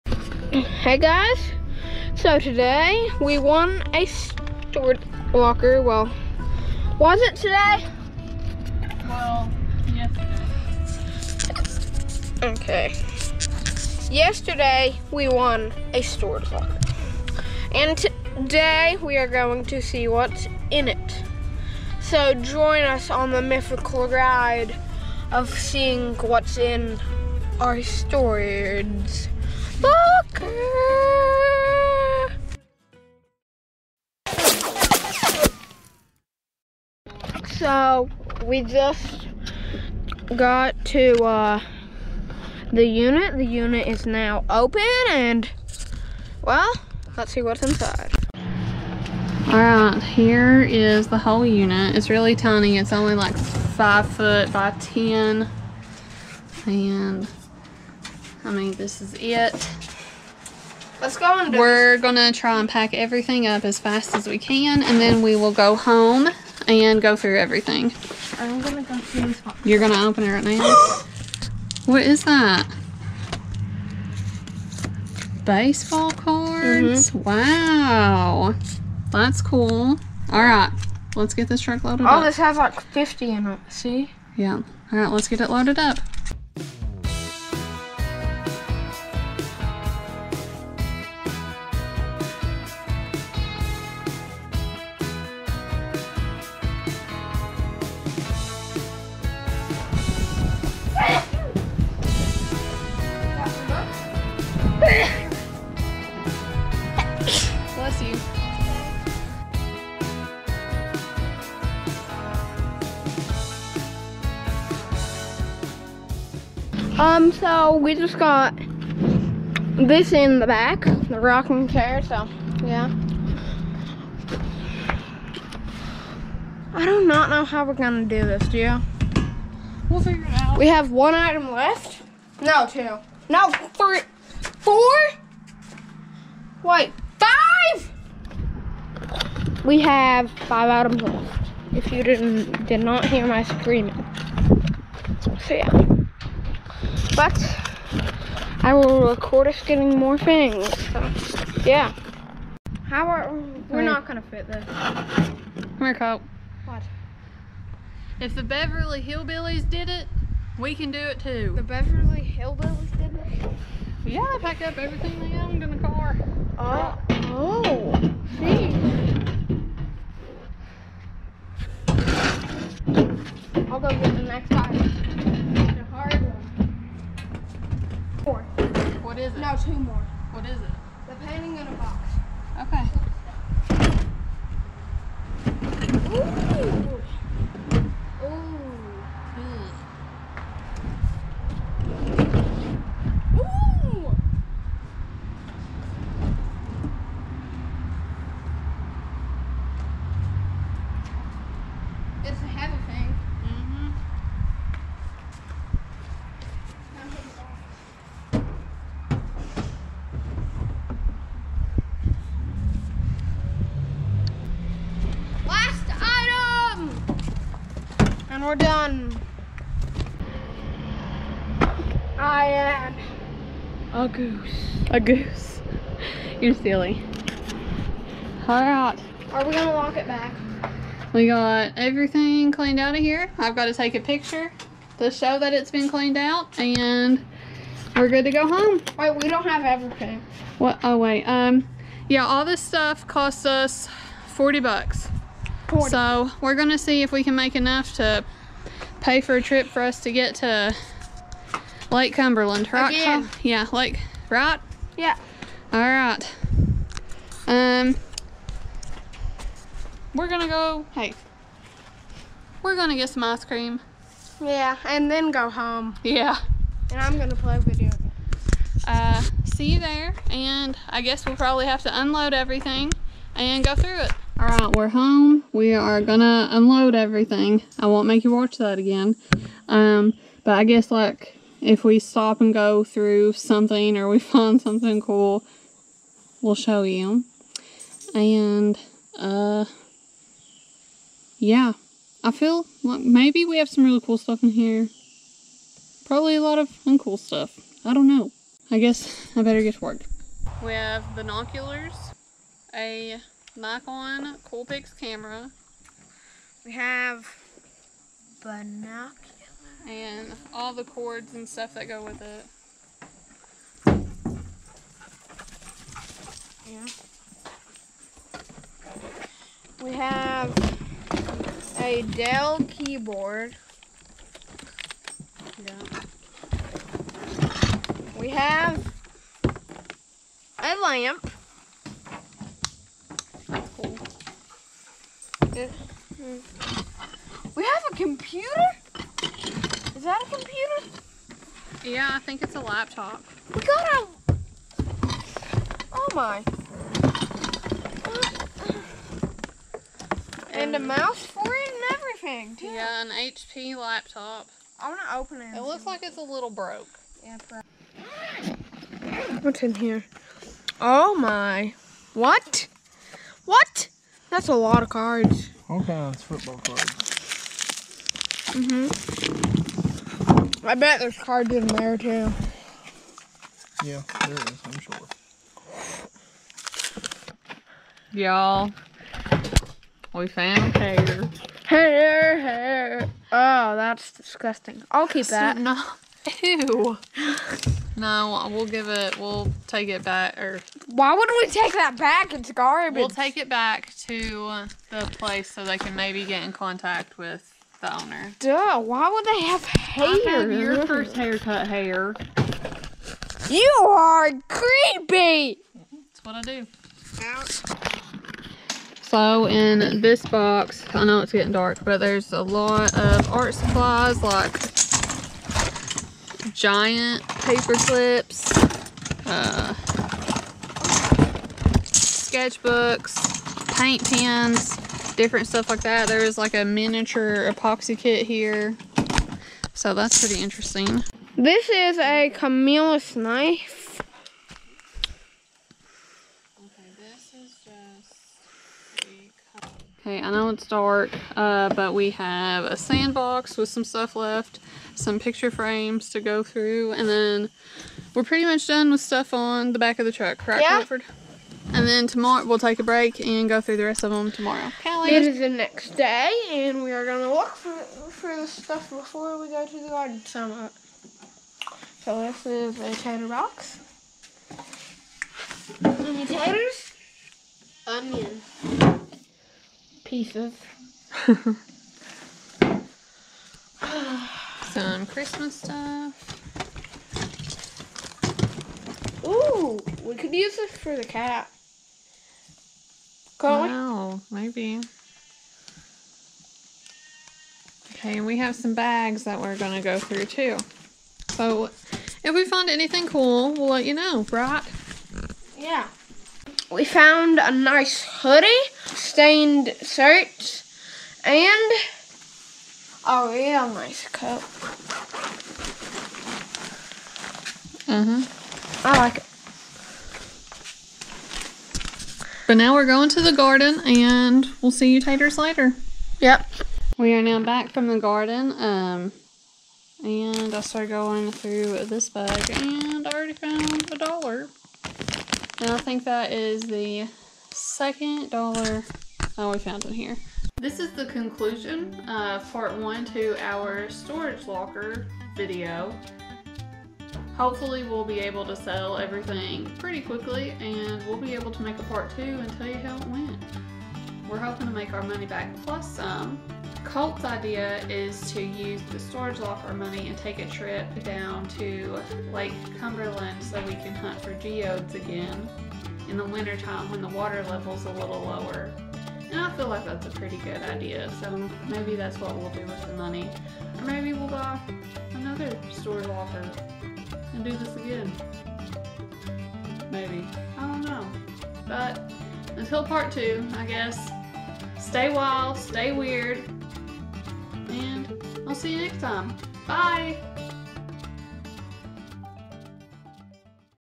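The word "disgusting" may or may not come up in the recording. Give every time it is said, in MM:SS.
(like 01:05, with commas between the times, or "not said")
06:24.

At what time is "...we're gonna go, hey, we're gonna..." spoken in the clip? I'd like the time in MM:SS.
04:20.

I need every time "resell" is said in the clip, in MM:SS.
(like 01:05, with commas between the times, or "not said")
not said.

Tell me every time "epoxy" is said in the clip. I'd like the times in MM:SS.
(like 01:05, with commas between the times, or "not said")
07:07.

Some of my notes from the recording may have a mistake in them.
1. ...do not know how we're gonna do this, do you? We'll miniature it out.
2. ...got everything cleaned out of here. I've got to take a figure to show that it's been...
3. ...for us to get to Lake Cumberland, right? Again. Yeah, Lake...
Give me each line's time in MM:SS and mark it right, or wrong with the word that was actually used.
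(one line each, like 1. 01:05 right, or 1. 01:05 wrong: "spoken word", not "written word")
1. 02:06 wrong: "figure", not "miniature"
2. 03:51 wrong: "picture", not "figure"
3. 04:09 right.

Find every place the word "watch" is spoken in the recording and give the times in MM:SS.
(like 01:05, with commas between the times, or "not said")
04:38.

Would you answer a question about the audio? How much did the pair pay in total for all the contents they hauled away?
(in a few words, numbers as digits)
$40.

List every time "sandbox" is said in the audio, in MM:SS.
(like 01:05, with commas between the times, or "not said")
07:22.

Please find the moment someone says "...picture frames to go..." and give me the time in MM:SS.
07:25.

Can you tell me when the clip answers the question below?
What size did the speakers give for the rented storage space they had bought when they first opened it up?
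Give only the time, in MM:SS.
00:53.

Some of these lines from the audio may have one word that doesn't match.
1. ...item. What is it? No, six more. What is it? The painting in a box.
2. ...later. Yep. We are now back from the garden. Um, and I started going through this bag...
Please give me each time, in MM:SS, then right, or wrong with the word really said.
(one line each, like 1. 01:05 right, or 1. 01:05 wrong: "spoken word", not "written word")
1. 02:54 wrong: "two", not "six"
2. 08:35 right.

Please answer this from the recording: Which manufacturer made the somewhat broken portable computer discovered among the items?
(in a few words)
HP.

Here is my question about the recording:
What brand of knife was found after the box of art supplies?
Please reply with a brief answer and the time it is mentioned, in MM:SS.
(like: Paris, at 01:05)
Camillus, at 07:12.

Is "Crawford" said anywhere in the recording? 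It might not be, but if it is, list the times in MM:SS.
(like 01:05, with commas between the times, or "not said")
07:30.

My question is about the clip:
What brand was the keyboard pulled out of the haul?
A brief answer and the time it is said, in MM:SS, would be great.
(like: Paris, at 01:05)
Dell, at 05:22.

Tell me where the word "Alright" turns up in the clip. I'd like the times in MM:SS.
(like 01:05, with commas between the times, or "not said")
00:49, 04:34.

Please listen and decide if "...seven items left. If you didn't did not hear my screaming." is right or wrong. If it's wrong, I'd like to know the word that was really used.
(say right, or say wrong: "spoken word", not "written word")
wrong: "five", not "seven".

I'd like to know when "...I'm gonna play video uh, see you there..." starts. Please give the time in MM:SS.
04:27.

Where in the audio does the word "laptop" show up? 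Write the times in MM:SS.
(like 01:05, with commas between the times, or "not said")
05:42, 05:53.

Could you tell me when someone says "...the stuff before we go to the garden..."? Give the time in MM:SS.
07:38.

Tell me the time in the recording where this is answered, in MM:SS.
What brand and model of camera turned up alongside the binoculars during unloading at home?
05:03.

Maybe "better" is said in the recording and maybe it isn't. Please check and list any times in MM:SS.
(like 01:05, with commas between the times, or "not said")
04:59.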